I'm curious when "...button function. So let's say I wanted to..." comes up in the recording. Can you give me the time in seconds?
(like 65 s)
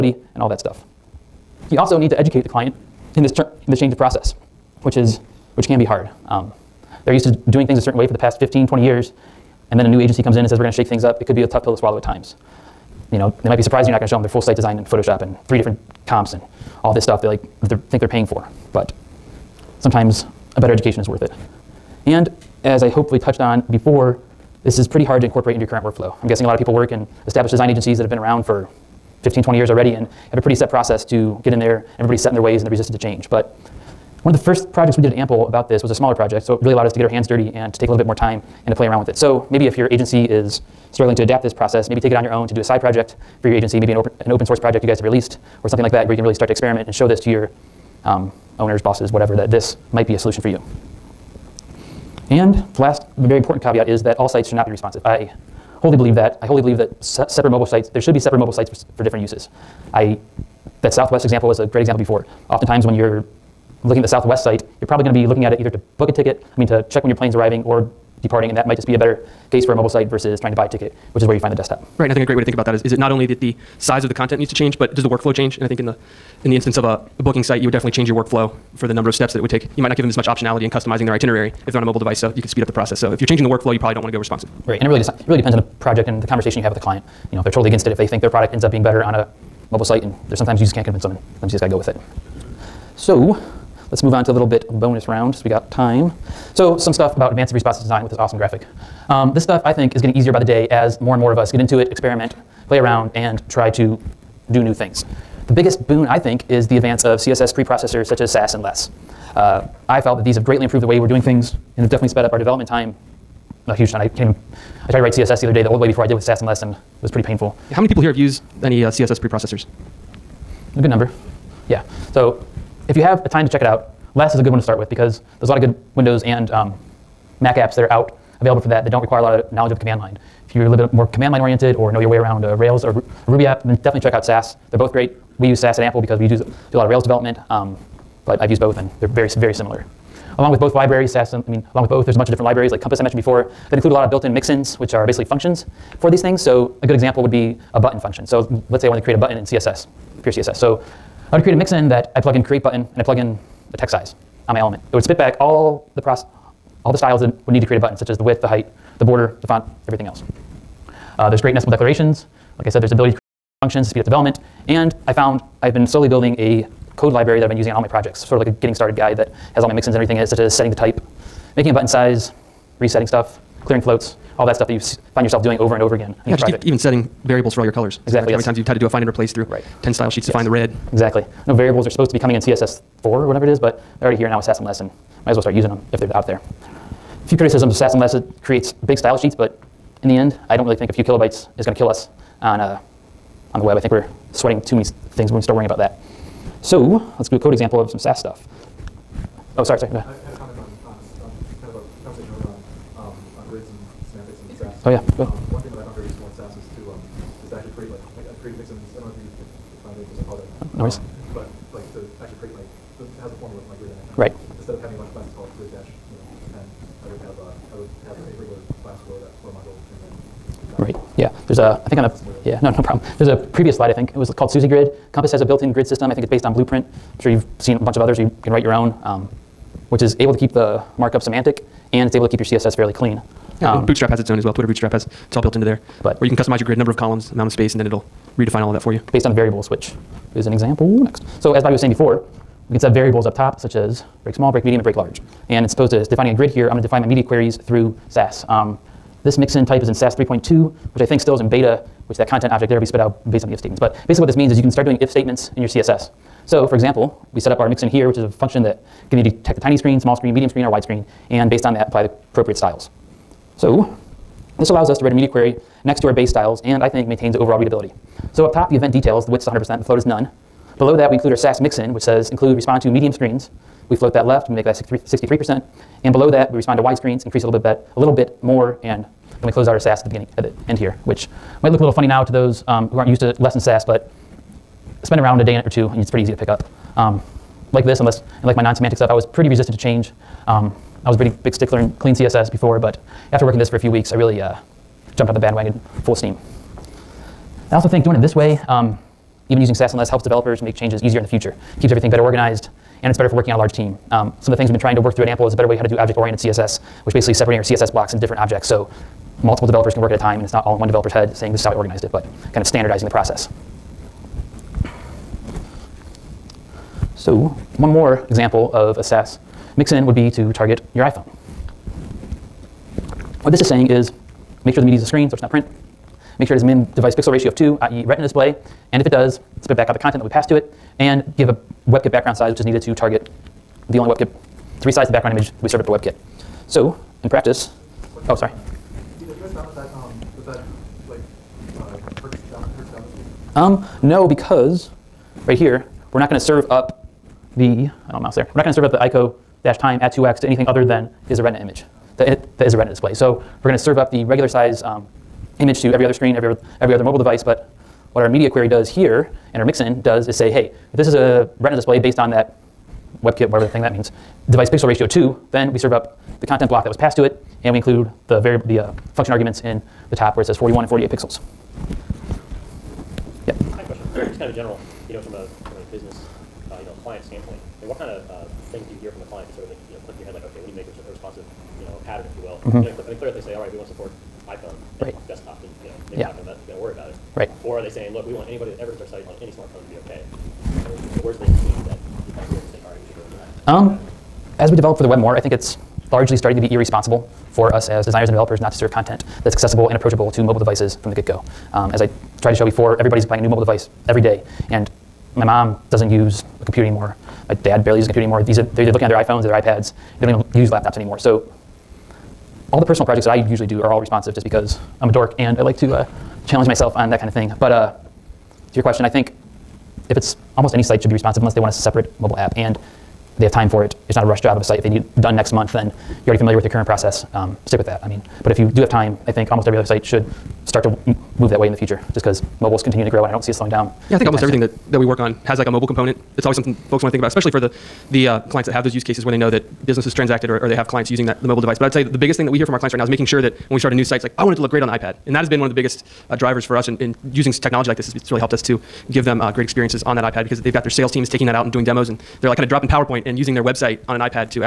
147 s.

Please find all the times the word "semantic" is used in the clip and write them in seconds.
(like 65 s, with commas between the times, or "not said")
231 s, 288 s.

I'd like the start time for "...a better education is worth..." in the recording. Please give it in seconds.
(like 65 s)
20 s.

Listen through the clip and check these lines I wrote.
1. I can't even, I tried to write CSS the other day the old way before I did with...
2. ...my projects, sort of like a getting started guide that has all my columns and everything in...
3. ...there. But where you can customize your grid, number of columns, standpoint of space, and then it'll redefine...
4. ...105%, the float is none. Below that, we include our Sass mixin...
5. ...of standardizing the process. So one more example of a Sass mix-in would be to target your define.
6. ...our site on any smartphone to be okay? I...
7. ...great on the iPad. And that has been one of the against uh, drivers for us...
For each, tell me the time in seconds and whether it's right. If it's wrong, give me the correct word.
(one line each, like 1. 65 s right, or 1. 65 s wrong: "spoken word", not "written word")
1. 113 s right
2. 167 s wrong: "mixins", not "columns"
3. 235 s wrong: "amount", not "standpoint"
4. 269 s wrong: "100", not "105"
5. 312 s wrong: "iPhone", not "define"
6. 389 s right
7. 444 s wrong: "biggest", not "against".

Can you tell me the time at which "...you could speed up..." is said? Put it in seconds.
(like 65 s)
82 s.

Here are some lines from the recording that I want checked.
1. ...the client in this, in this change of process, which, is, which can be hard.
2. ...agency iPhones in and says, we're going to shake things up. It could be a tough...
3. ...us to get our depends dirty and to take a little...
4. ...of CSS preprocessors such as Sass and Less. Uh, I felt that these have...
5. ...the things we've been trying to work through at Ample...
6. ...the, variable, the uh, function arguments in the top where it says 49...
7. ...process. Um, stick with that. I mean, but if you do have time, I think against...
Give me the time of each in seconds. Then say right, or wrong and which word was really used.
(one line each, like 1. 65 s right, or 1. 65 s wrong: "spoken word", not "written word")
1. 2 s right
2. 9 s wrong: "comes", not "iPhones"
3. 36 s wrong: "hands", not "depends"
4. 107 s right
5. 304 s right
6. 368 s wrong: "41", not "49"
7. 426 s wrong: "almost", not "against".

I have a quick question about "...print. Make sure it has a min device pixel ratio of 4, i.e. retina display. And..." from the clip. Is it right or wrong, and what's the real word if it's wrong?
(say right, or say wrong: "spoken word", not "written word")
wrong: "2", not "4".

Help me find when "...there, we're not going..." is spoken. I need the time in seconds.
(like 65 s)
348 s.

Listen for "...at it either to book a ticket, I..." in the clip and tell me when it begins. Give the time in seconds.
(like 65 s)
65 s.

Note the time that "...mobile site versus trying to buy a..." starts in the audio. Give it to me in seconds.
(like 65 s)
69 s.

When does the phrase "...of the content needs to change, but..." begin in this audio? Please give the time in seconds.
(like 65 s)
74 s.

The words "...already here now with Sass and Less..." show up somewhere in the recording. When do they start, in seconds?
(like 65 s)
184 s.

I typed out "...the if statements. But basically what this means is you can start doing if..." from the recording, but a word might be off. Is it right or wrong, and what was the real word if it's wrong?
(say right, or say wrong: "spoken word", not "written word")
right.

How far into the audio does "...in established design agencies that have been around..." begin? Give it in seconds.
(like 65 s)
26 s.